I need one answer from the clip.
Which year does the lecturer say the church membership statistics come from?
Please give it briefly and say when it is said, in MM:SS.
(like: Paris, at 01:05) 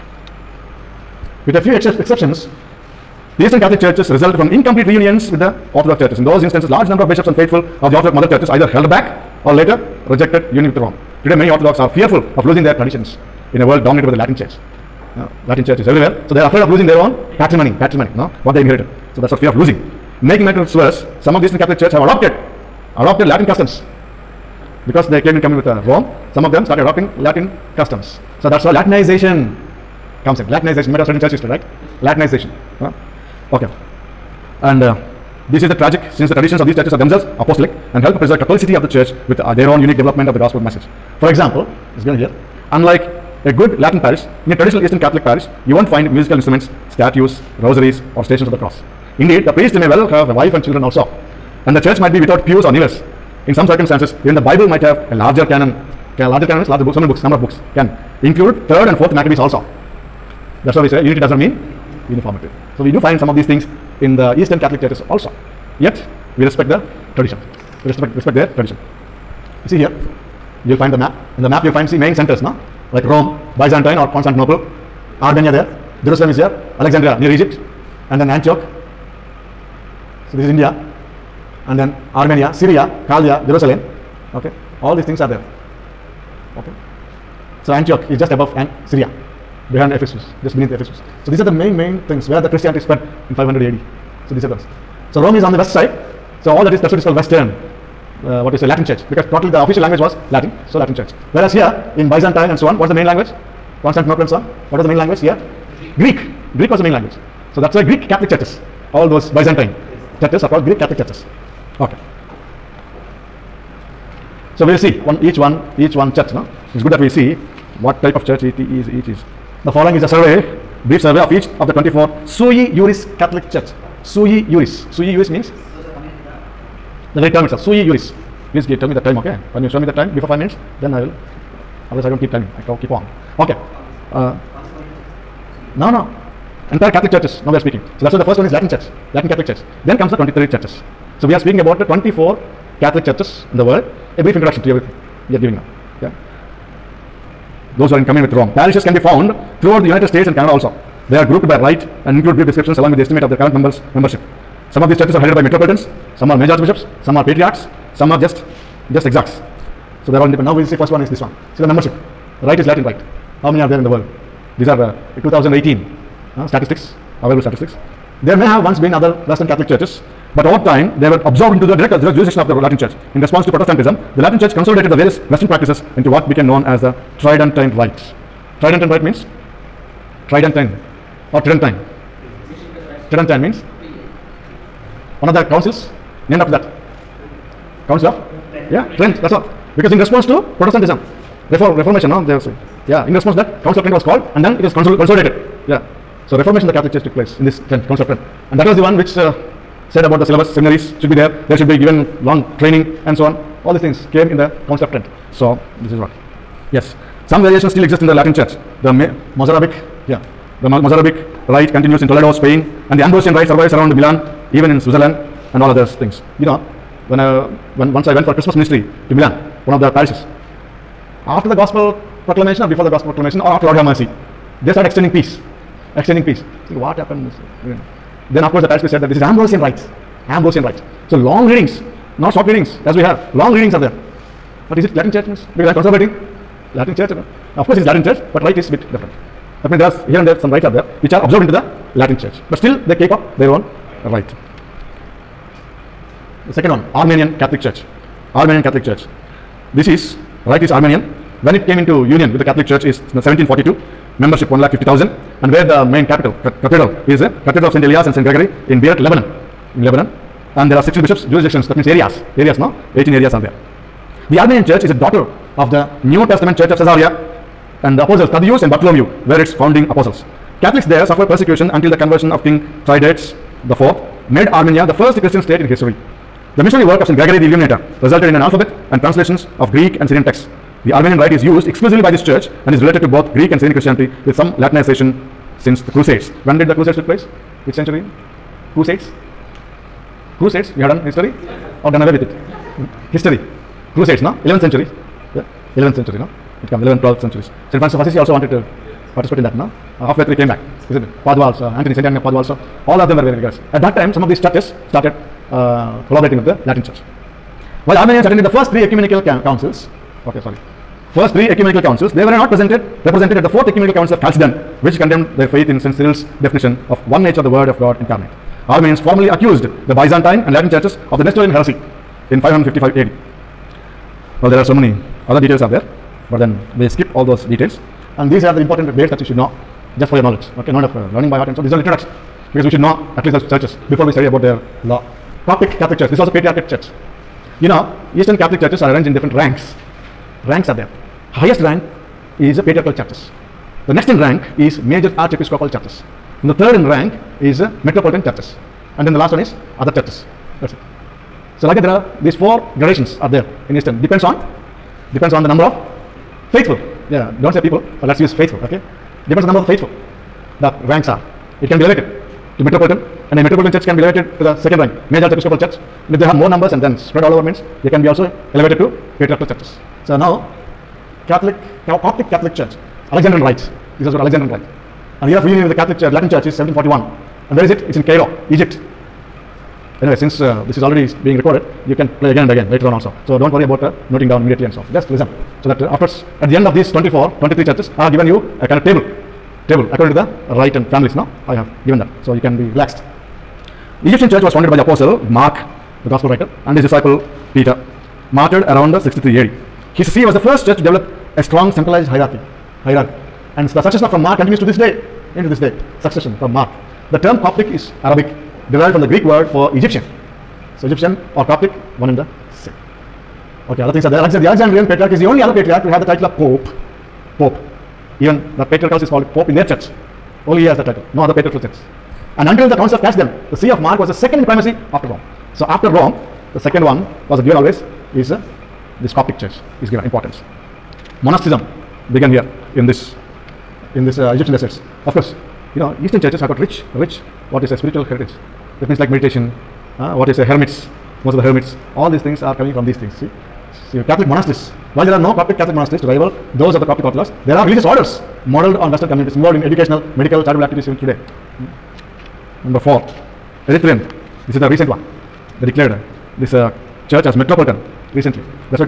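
2018, at 02:45.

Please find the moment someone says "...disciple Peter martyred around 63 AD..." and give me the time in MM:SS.
06:36.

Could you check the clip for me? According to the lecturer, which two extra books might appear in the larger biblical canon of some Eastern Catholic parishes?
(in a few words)
Third and Fourth Maccabees.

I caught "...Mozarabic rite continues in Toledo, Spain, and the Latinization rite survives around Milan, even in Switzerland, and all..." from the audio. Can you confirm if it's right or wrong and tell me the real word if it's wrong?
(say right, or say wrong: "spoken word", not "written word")
wrong: "Ambrosian", not "Latinization".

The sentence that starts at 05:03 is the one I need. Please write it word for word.
At that time, some of these churches started uh, collaborating with the Latin Church.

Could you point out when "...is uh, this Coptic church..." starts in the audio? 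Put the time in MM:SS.
07:08.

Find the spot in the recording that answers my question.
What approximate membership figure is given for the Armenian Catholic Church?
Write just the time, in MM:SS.
04:14.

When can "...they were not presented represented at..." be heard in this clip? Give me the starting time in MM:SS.
05:12.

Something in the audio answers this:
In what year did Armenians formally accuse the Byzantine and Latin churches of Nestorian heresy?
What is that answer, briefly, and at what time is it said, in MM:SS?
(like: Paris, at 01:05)
555 AD, at 05:22.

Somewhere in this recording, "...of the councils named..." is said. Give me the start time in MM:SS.
03:05.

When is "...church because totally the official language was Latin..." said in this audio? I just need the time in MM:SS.
01:38.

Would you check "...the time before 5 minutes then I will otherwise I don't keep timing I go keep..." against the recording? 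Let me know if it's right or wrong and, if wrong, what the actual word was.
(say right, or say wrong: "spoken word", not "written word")
right.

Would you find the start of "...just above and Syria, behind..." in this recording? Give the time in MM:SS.
01:28.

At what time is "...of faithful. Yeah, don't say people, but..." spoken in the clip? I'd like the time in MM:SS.
05:55.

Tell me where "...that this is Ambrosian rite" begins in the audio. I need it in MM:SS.
03:49.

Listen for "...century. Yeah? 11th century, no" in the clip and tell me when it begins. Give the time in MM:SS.
04:54.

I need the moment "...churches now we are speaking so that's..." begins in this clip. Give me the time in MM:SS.
02:17.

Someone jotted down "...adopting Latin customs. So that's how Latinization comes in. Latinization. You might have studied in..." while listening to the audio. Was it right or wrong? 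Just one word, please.
right.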